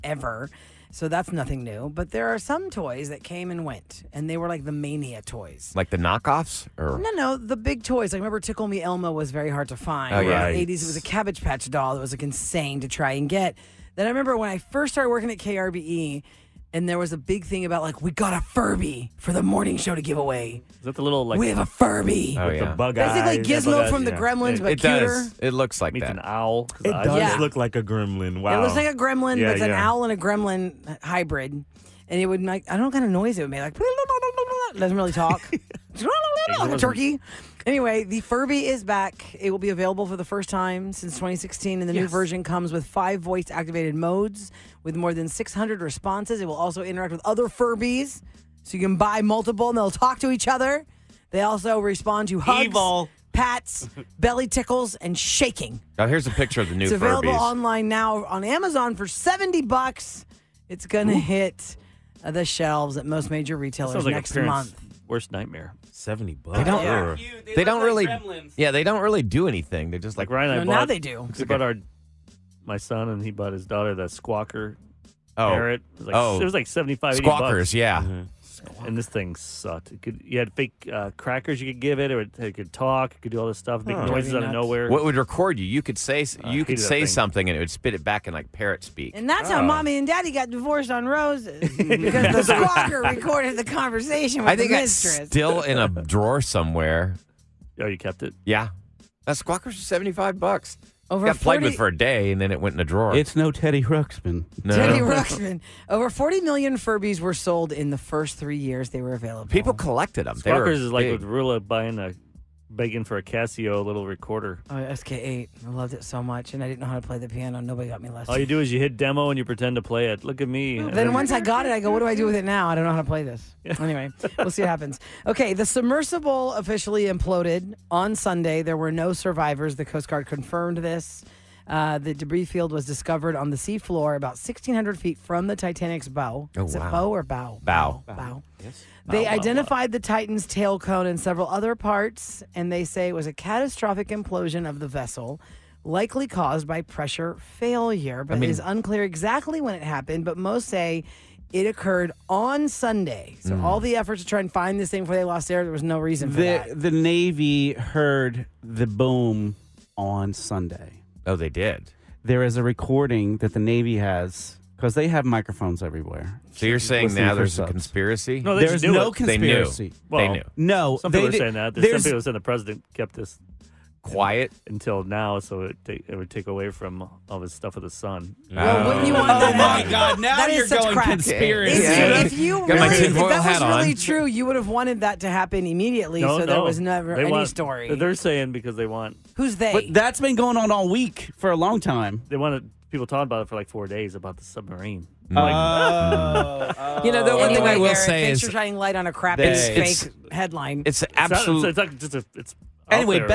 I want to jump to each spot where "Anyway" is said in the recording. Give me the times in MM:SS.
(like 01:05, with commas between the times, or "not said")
00:37, 02:03.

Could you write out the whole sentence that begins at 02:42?
There is a recording that the Navy has because they have microphones everywhere.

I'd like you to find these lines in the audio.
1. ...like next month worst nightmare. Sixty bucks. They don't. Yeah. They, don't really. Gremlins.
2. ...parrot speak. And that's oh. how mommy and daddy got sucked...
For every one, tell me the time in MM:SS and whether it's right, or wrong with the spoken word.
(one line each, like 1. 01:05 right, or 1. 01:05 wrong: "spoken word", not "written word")
1. 01:04 wrong: "Seventy", not "Sixty"
2. 01:28 wrong: "divorced", not "sucked".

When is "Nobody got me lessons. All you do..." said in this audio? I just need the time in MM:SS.
01:57.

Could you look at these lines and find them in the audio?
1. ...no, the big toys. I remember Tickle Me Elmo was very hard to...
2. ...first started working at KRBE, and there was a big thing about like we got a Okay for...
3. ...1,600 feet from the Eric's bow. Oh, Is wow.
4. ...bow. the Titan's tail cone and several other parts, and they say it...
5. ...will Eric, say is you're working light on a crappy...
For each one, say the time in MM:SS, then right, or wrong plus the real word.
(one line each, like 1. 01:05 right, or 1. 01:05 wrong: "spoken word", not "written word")
1. 00:07 right
2. 00:14 wrong: "Furby", not "Okay"
3. 02:14 wrong: "Titanic", not "Eric"
4. 02:19 right
5. 03:17 wrong: "shining", not "working".